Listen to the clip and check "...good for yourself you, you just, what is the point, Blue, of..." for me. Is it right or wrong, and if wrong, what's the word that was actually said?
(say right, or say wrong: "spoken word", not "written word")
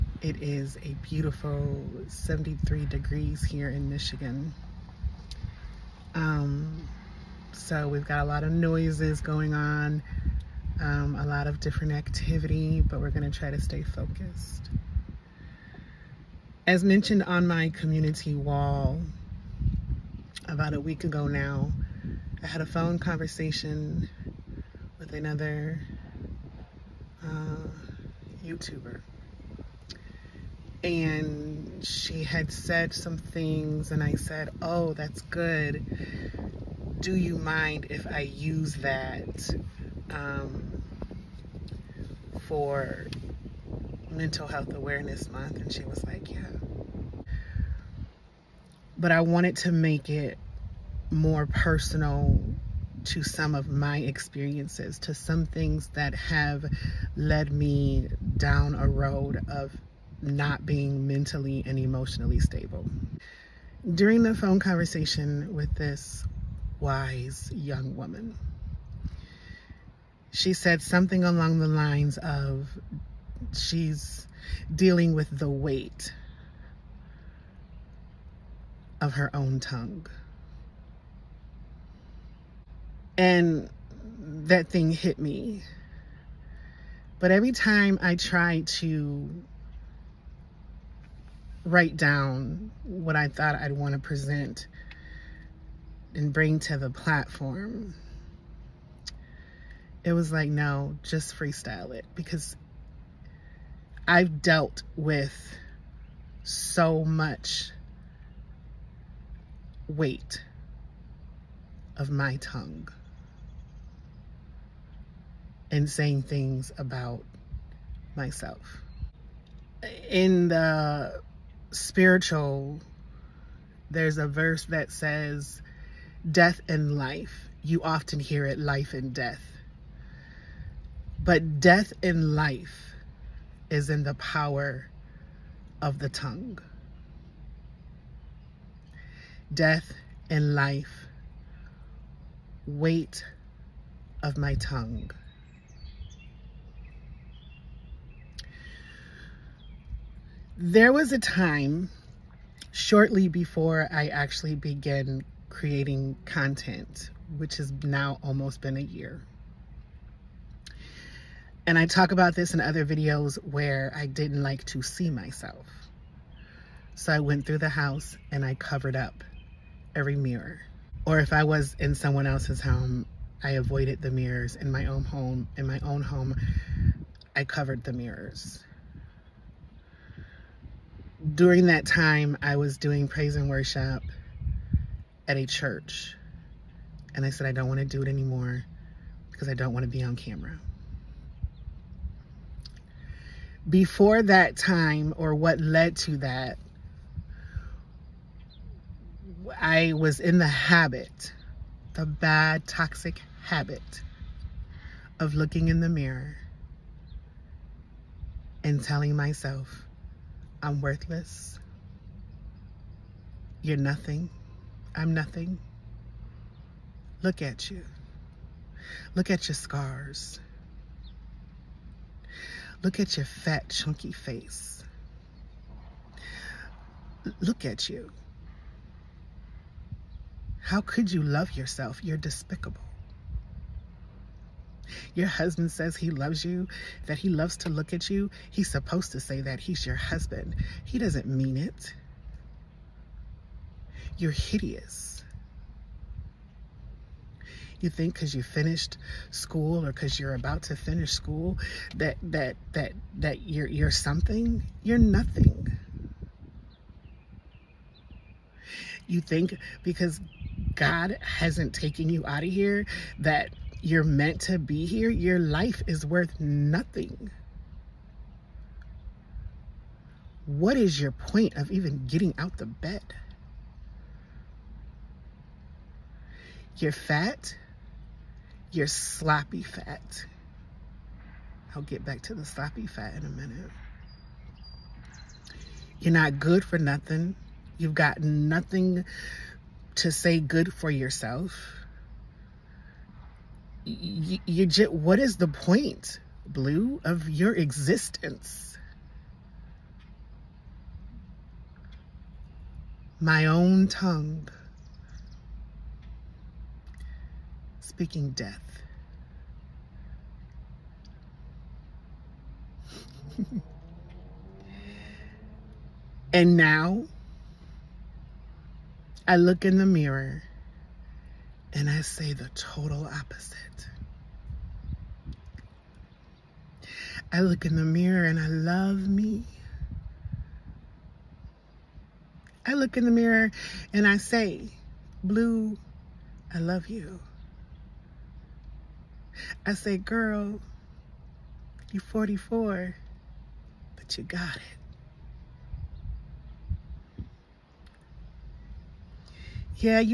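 right.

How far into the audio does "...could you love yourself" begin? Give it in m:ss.
3:50.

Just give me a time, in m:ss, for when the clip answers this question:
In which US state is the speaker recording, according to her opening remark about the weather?
0:03.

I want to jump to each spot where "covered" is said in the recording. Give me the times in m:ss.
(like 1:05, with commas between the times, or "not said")
2:48, 2:57.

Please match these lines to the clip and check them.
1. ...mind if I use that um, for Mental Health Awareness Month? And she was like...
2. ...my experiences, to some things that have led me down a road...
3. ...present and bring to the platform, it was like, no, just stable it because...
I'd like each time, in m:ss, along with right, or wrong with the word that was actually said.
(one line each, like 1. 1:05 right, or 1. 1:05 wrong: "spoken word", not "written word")
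1. 0:37 right
2. 0:53 right
3. 1:33 wrong: "freestyle", not "stable".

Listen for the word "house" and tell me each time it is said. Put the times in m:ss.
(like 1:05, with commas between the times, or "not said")
2:47.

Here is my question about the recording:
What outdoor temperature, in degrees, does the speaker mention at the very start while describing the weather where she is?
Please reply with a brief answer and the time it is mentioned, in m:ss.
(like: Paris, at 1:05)
73, at 0:02.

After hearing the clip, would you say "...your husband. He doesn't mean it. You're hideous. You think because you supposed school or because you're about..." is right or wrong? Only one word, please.
wrong.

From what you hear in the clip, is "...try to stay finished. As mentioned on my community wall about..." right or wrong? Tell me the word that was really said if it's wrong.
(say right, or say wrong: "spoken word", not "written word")
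wrong: "focused", not "finished".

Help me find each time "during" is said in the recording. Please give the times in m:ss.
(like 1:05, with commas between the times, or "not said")
1:03, 3:01.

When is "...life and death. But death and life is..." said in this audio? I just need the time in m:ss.
2:08.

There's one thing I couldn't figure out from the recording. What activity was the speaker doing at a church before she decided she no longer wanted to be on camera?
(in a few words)
Praise and worship.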